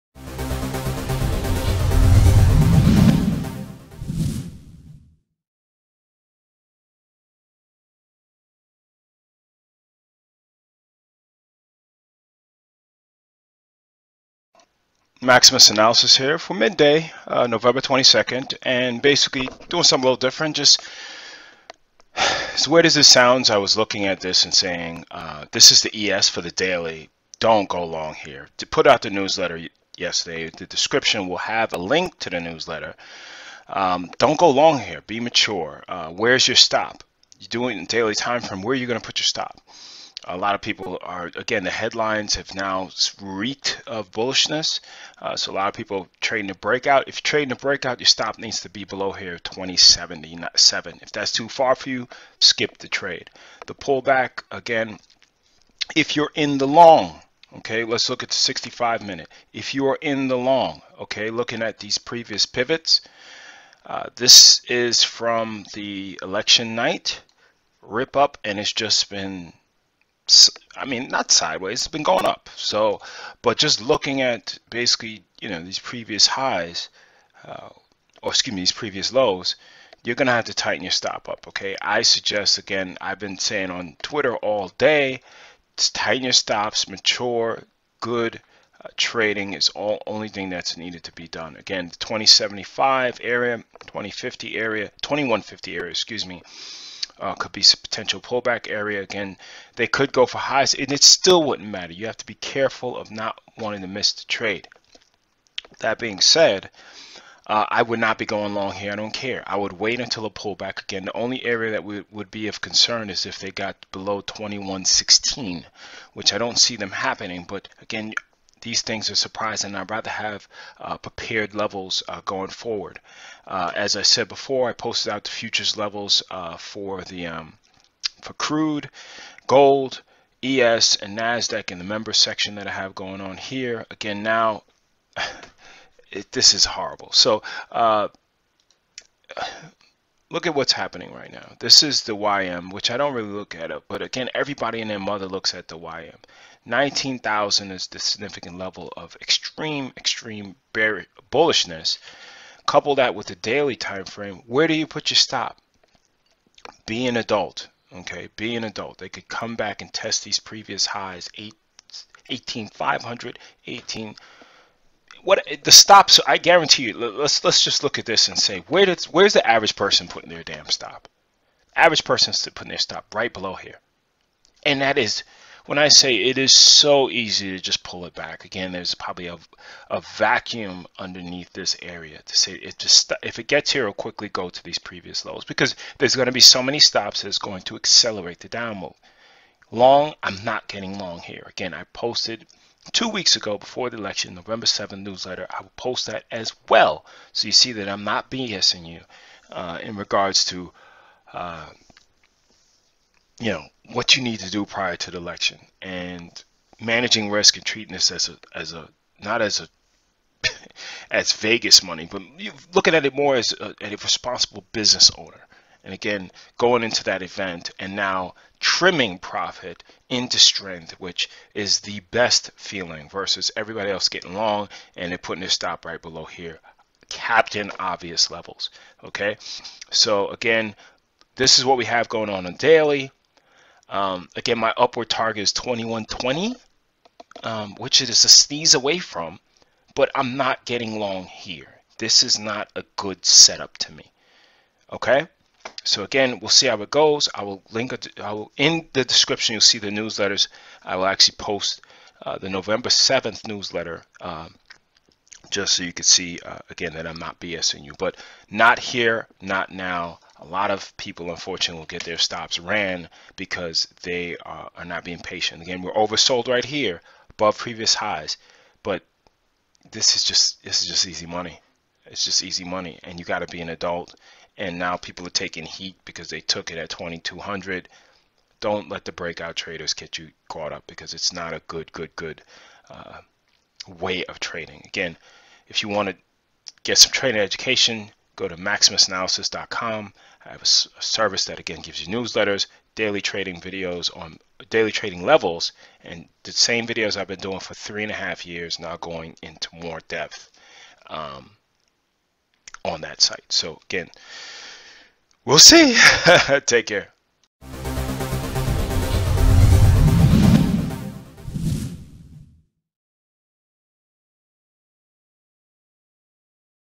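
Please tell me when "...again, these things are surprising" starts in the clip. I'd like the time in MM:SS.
01:57.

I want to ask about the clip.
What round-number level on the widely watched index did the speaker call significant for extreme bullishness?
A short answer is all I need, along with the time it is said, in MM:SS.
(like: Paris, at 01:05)
19,000, at 02:26.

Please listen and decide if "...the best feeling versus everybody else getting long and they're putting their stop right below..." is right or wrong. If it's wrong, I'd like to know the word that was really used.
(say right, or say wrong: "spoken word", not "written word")
right.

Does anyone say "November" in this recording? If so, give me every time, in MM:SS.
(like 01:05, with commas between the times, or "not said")
00:17, 03:14, 04:12.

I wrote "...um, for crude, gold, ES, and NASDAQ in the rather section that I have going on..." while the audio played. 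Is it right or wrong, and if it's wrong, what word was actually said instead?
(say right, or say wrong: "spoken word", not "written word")
wrong: "member", not "rather".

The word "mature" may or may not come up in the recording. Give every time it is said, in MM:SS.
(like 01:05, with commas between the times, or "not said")
00:35, 01:26.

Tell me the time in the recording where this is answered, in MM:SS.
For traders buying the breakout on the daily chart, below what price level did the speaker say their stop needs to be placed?
00:49.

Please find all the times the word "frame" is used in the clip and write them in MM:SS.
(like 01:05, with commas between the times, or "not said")
00:38, 02:34.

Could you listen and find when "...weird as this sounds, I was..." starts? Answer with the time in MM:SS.
00:22.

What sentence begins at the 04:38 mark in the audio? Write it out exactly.
Don't let the breakout traders get you caught up because it's not a good, good, good uh, way of trading.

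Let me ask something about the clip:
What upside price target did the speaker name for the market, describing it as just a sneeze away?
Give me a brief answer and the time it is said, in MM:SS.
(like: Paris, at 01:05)
2120, at 03:55.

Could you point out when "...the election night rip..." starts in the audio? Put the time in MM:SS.
01:05.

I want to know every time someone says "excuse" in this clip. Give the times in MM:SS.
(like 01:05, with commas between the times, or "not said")
01:18, 01:35.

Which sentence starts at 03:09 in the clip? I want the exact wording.
Long, I'm not getting long here.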